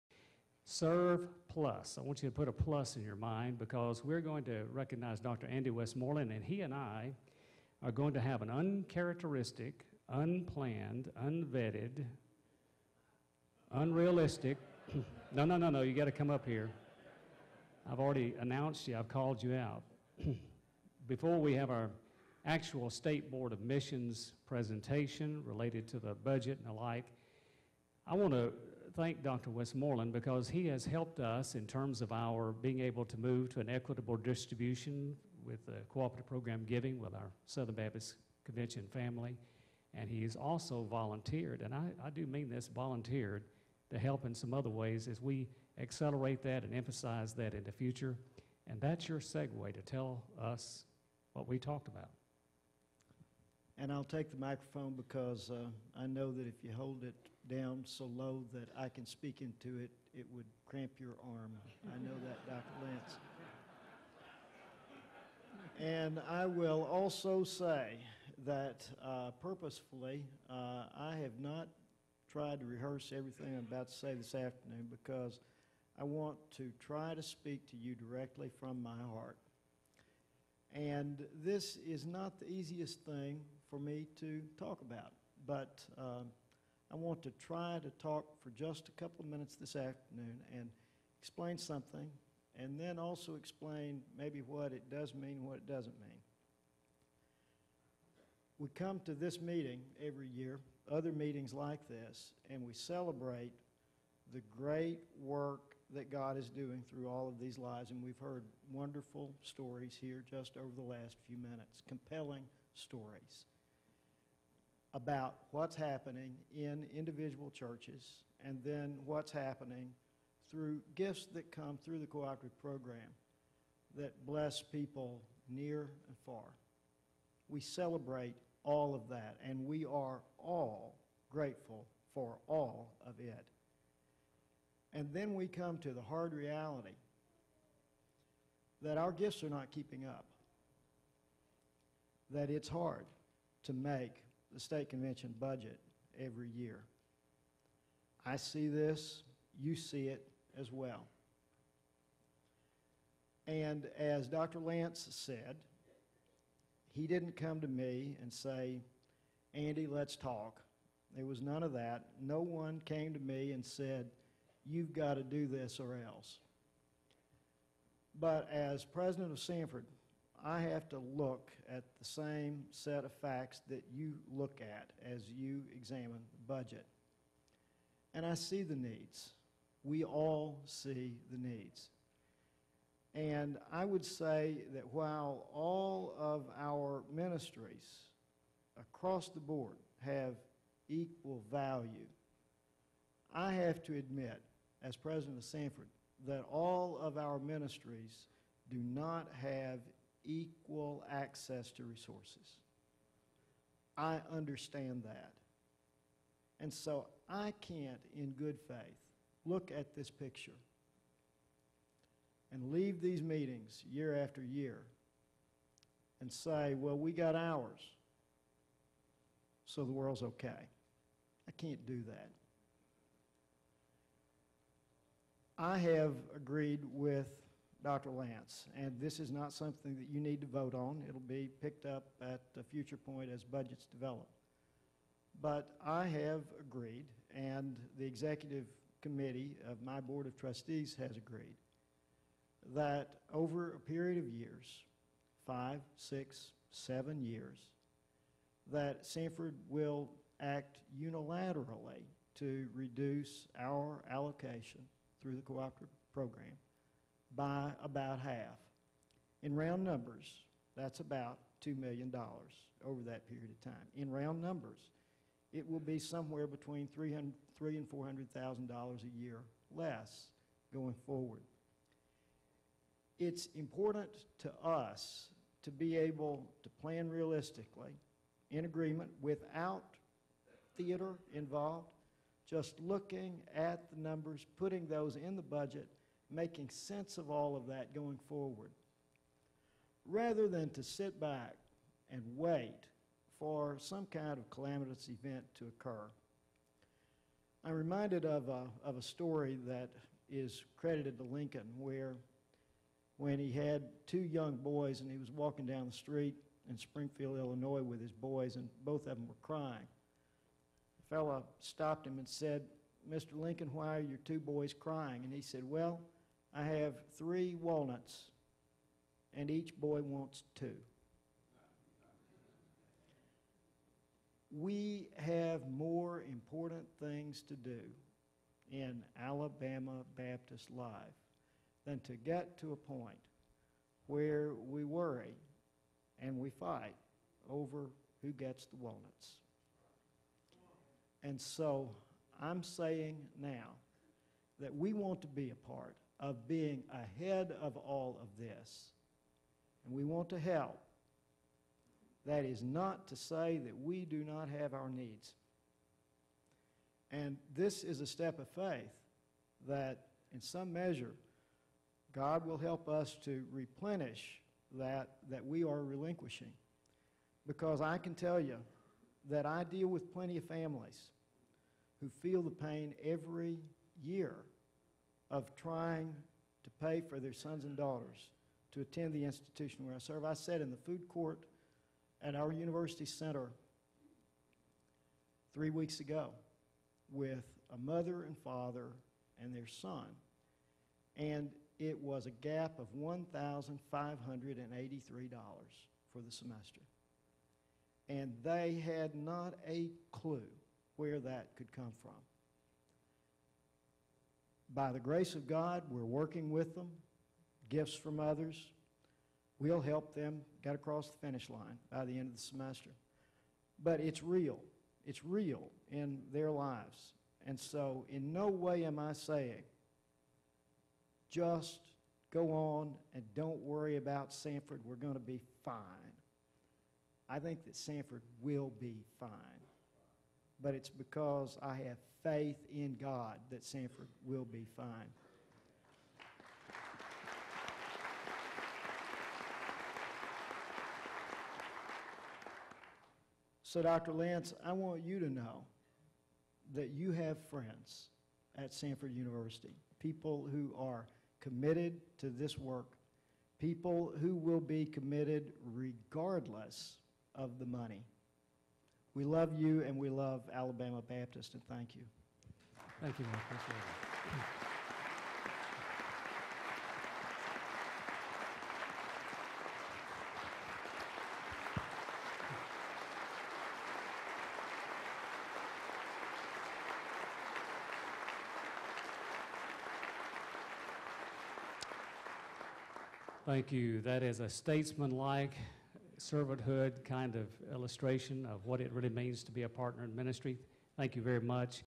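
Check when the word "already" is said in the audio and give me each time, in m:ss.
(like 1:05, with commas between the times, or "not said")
0:17.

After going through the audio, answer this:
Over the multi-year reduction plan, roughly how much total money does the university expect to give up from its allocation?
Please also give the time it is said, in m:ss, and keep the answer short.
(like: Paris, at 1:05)
$2 million, at 4:21.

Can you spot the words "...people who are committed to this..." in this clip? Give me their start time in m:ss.
7:29.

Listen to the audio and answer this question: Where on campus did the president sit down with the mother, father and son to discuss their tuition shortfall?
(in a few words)
food court.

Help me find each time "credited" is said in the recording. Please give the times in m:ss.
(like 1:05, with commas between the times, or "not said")
5:00.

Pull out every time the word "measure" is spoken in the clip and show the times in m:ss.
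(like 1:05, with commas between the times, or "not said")
6:00.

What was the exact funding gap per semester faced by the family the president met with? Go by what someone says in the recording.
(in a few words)
$1,583.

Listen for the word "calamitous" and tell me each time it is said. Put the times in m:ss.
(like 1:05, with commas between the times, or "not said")
4:54.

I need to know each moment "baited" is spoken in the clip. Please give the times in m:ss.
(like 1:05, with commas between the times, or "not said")
not said.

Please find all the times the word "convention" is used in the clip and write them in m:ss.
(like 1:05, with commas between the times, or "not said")
0:38, 2:24.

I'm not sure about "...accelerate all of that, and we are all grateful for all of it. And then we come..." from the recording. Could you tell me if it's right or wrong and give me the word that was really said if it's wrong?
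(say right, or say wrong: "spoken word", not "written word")
wrong: "celebrate", not "accelerate".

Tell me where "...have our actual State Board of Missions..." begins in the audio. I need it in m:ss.
0:21.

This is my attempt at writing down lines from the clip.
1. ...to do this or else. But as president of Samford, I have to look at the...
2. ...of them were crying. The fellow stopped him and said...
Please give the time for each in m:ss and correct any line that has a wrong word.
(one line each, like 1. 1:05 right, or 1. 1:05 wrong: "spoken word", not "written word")
1. 2:45 right
2. 5:09 right.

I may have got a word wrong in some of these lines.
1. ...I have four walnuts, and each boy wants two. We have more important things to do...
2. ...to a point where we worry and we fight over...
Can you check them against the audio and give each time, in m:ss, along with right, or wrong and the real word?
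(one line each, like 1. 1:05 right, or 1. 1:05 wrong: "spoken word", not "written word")
1. 5:16 wrong: "three", not "four"
2. 5:32 right.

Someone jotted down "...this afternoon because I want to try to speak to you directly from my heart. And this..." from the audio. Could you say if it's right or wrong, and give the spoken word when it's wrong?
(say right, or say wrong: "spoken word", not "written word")
right.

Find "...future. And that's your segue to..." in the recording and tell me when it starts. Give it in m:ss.
0:47.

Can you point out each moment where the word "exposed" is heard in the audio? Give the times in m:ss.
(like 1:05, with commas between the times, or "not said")
not said.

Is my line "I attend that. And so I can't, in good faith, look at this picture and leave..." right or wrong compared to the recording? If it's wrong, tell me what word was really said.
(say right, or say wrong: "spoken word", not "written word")
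wrong: "understand", not "attend".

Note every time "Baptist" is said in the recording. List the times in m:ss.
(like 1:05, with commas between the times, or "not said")
0:37, 5:30, 7:41.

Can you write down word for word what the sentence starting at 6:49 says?
We'll help them get across the finish line by the end of the semester.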